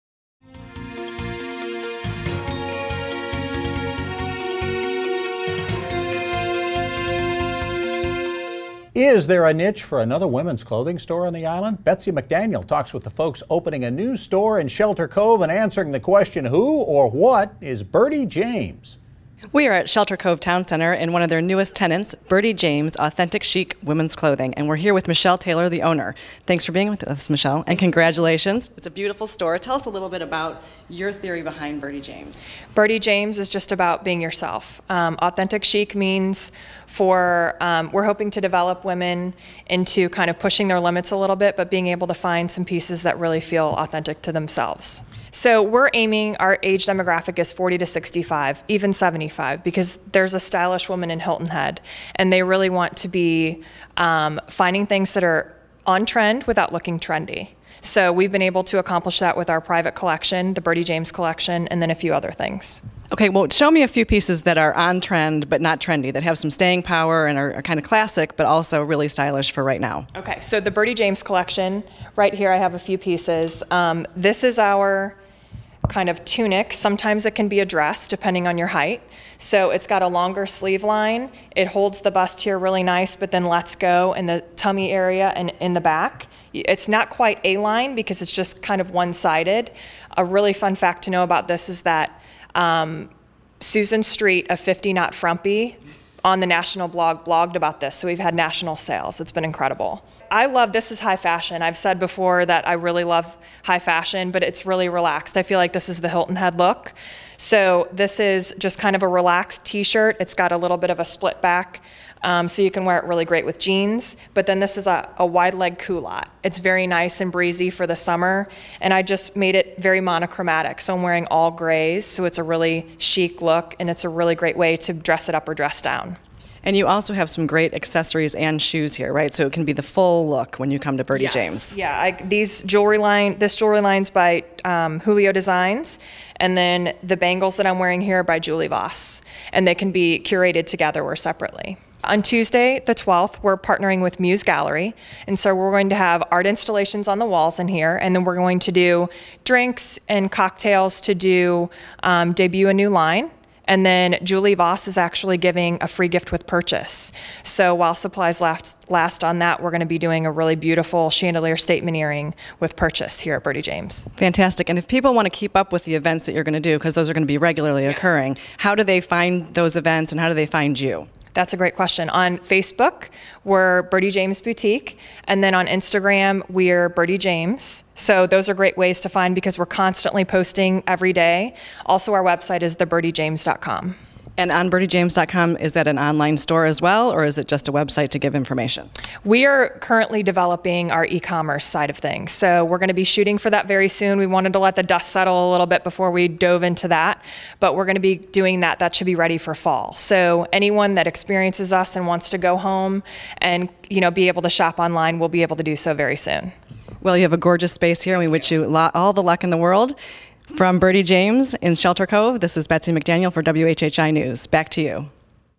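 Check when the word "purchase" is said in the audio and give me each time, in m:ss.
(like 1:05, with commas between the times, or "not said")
2:36, 2:42.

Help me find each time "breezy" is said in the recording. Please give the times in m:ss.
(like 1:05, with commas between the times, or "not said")
1:57.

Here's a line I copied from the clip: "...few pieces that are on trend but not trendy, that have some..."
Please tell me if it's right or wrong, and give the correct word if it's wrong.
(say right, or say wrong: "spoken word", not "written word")
right.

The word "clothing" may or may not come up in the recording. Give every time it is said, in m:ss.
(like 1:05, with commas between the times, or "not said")
0:10, 0:24.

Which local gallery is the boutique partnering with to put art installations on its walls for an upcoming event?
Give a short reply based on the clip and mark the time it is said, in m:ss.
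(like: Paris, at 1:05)
Muse Gallery, at 2:24.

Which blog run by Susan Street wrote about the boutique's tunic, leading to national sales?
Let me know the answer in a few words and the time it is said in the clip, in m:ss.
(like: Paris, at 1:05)
50 Not Frumpy, at 1:34.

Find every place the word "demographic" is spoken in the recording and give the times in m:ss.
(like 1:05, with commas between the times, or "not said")
0:46.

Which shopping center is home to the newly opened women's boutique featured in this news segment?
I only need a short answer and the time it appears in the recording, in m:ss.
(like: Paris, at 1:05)
Shelter Cove Town Center, at 0:19.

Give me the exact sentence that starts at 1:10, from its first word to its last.
Okay, so the Birdie James collection, right here I have a few pieces.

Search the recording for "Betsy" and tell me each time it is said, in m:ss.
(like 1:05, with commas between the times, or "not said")
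0:11, 3:32.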